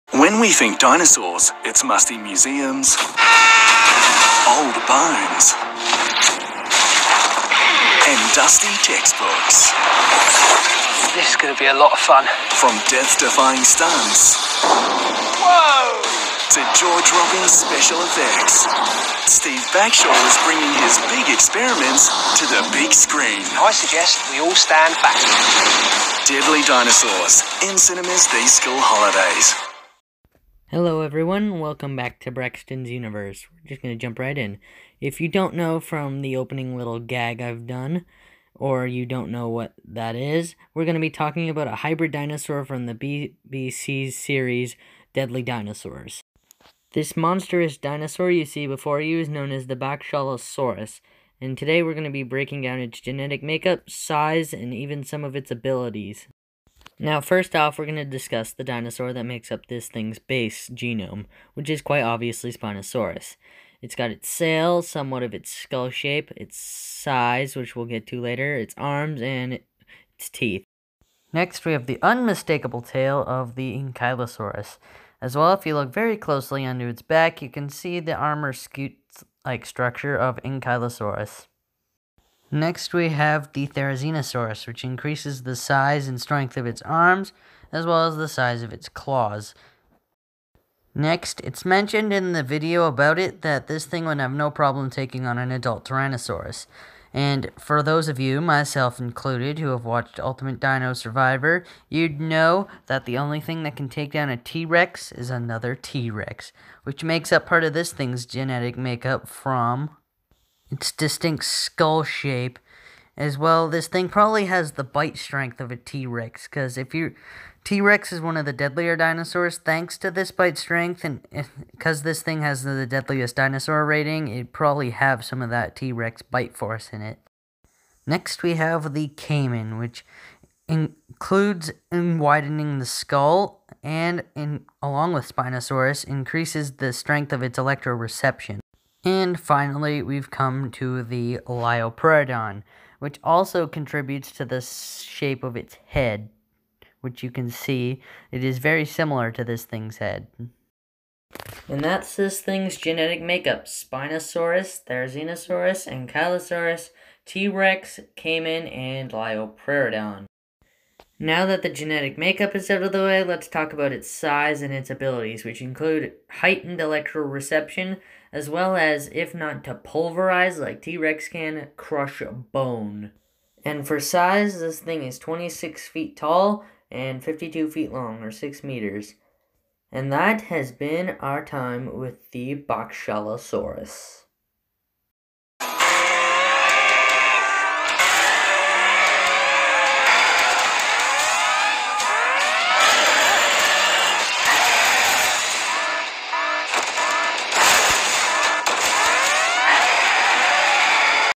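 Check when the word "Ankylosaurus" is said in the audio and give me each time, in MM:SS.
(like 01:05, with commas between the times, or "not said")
01:13, 01:20, 02:35.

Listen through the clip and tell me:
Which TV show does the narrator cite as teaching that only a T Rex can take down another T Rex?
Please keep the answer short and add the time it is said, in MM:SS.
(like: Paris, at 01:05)
Ultimate Dino Survivor, at 01:40.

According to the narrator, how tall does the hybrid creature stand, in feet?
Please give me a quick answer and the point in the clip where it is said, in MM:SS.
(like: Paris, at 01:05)
26 feet, at 02:55.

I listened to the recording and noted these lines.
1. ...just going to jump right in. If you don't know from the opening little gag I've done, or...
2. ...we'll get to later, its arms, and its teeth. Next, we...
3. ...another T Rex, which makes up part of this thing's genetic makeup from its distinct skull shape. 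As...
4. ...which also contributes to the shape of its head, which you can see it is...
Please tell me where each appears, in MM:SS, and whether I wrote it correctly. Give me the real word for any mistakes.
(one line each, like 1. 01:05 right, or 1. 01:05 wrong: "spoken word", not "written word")
1. 00:33 right
2. 01:07 right
3. 01:45 right
4. 02:22 right.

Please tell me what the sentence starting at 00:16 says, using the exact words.
to jaw-dropping special effects, Steve Backshall is bringing his big experiments to the big screen.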